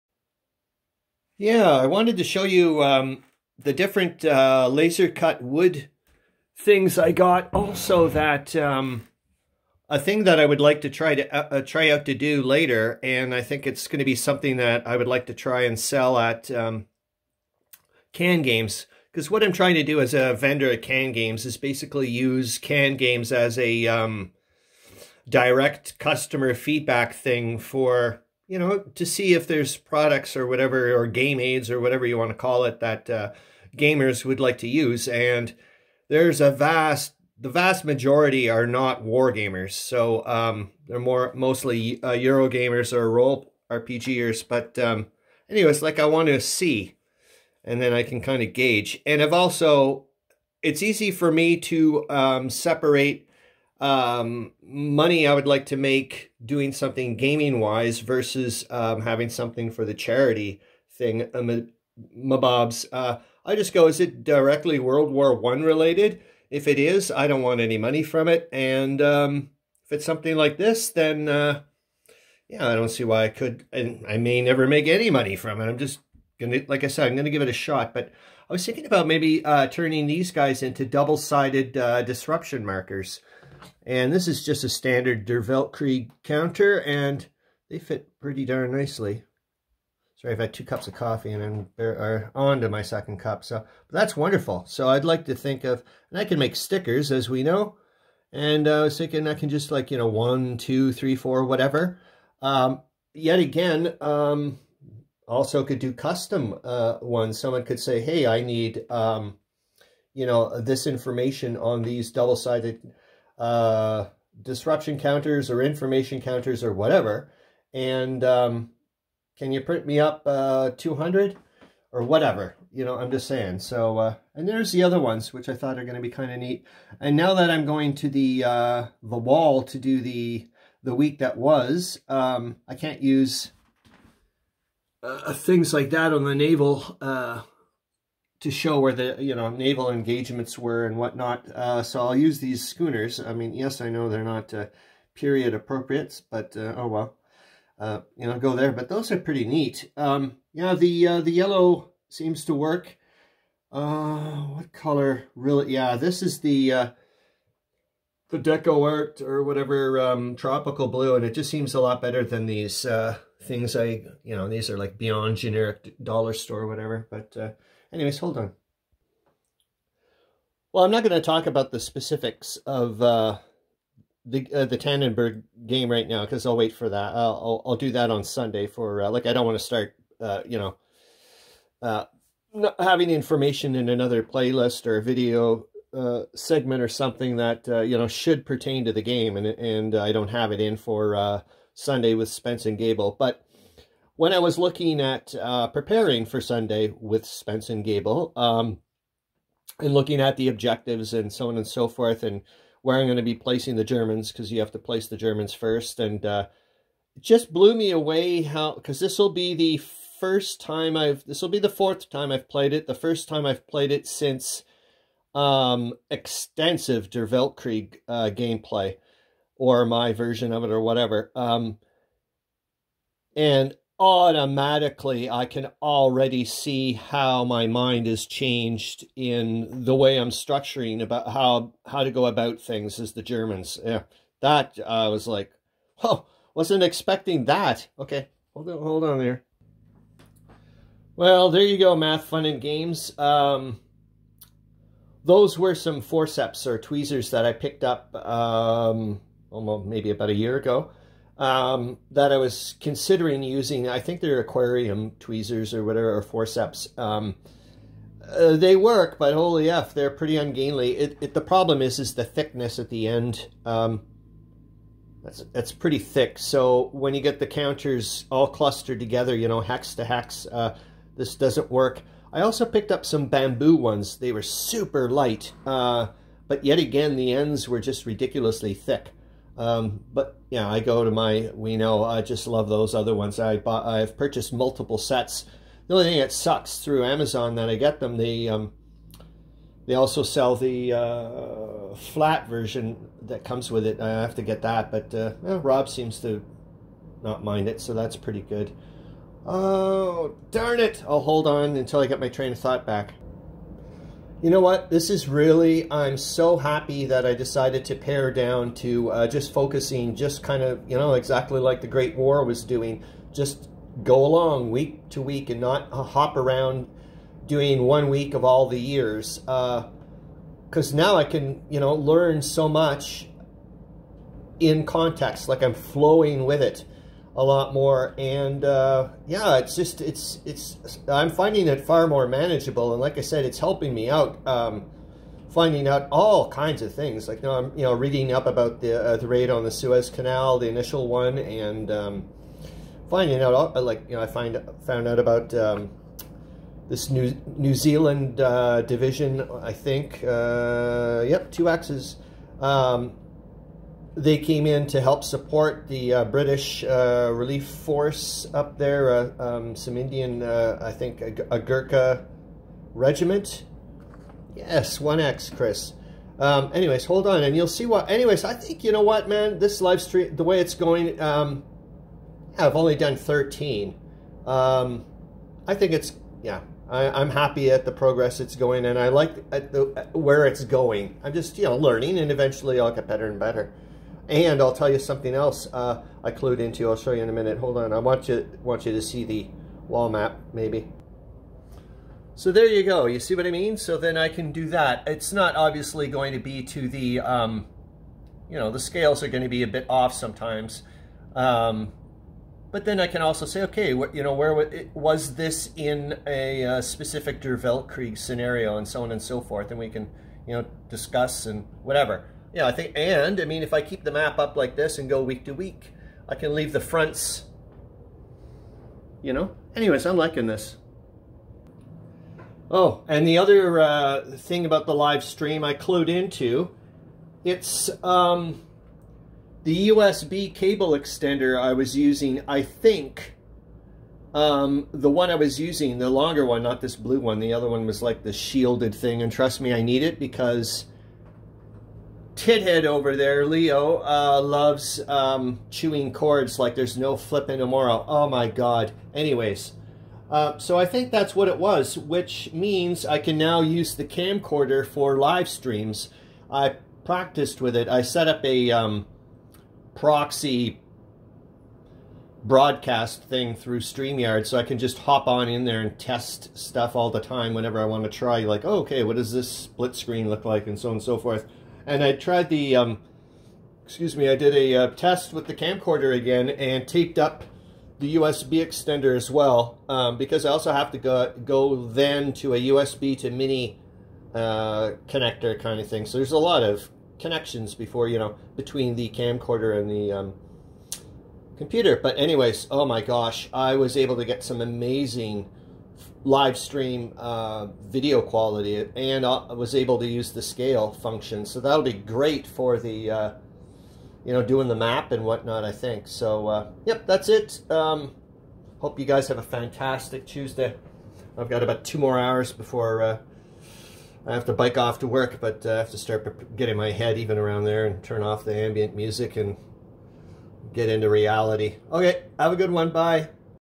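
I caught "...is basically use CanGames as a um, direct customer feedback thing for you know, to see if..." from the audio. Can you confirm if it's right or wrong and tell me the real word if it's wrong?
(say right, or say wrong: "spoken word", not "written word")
right.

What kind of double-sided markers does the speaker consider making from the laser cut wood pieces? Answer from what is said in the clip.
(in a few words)
disruption markers.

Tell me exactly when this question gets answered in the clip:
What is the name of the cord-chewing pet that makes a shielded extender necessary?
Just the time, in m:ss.
7:23.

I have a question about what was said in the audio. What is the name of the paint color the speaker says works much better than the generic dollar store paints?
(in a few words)
tropical blue.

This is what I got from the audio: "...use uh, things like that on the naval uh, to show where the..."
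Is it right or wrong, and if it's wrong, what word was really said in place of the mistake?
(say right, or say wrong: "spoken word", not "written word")
right.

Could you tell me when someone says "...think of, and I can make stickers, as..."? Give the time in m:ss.
1:35.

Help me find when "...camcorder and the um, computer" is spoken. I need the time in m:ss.
8:09.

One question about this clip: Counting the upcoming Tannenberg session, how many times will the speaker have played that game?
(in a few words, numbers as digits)
4.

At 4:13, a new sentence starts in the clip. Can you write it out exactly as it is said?
I think they're aquarium tweezers or whatever, or forceps.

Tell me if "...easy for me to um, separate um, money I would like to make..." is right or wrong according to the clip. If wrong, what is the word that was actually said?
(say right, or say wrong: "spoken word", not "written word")
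right.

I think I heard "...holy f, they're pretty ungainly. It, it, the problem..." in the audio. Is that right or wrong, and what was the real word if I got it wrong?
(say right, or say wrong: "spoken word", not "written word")
right.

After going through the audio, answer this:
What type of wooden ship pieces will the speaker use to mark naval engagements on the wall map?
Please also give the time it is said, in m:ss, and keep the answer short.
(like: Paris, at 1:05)
schooners, at 2:22.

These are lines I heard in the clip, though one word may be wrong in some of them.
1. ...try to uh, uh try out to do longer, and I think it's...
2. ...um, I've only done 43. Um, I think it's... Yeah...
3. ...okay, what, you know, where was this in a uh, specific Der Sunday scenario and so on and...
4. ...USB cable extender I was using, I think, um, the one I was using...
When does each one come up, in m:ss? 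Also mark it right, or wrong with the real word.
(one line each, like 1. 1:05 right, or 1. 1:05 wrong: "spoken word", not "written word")
1. 0:10 wrong: "later", not "longer"
2. 6:11 wrong: "13", not "43"
3. 6:43 wrong: "Weltkrieg", not "Sunday"
4. 7:09 right.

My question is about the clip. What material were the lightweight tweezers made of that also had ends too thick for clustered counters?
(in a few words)
bamboo.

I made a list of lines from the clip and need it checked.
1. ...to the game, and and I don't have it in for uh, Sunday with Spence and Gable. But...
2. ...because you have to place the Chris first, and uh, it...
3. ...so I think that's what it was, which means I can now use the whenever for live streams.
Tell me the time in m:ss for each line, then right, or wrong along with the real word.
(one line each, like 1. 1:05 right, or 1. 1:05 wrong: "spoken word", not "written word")
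1. 3:08 right
2. 3:24 wrong: "Germans", not "Chris"
3. 7:30 wrong: "camcorder", not "whenever".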